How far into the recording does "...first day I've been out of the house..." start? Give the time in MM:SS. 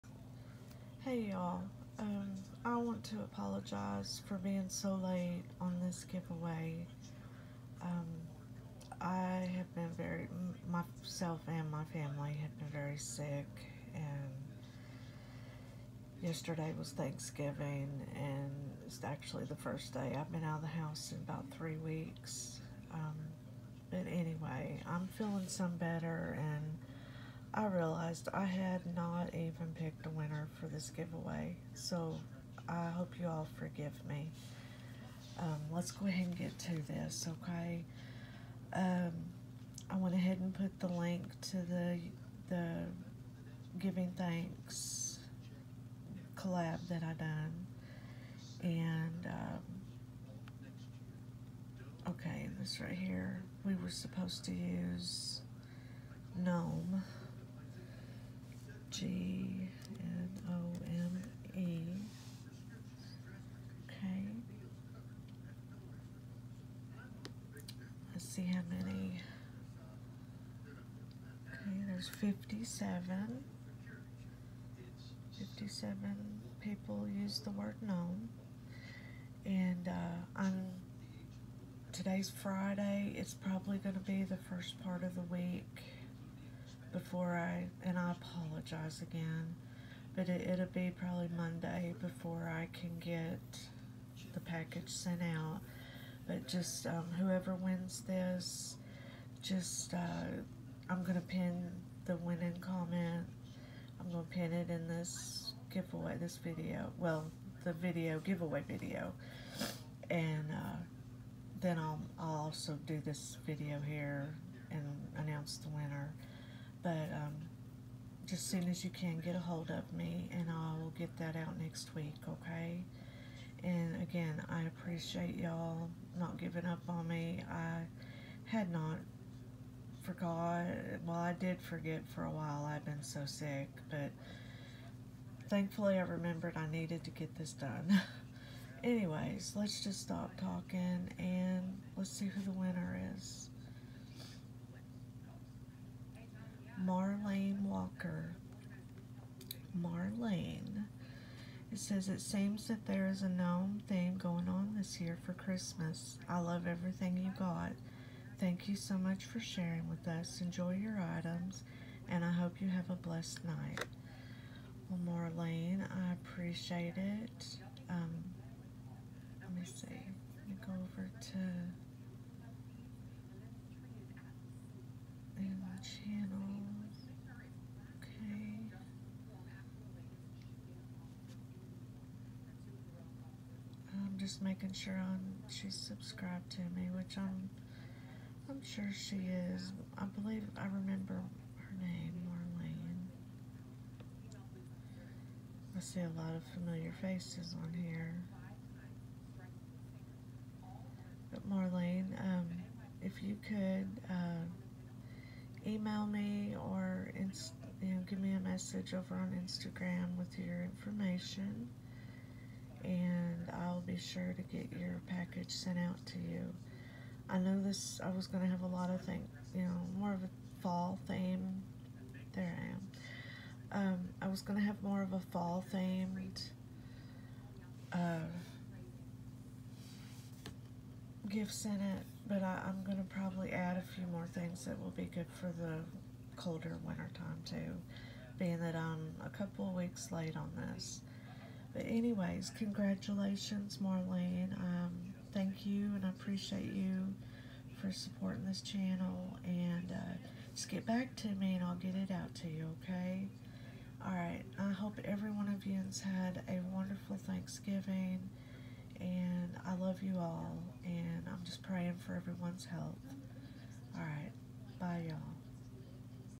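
00:19.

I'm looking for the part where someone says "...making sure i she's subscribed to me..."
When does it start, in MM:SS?
03:04.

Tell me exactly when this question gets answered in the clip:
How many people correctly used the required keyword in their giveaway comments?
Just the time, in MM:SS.
01:11.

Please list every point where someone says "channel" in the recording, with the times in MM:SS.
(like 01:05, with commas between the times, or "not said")
02:56, 04:08.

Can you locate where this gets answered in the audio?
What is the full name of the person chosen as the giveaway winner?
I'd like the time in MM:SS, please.
02:26.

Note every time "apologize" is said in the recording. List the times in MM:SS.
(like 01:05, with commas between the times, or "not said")
00:03, 01:28.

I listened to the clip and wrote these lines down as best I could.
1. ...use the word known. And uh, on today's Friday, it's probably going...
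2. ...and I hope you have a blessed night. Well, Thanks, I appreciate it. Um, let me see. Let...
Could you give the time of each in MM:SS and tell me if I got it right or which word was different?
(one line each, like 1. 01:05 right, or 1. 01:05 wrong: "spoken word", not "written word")
1. 01:17 right
2. 02:42 wrong: "Marlene", not "Thanks".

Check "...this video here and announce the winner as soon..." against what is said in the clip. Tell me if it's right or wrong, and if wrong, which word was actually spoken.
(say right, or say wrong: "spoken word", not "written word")
right.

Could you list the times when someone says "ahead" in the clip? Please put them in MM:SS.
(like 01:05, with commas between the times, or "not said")
00:36, 00:40.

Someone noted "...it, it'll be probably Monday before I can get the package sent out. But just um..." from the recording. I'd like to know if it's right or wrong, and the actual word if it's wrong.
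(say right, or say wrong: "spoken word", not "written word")
right.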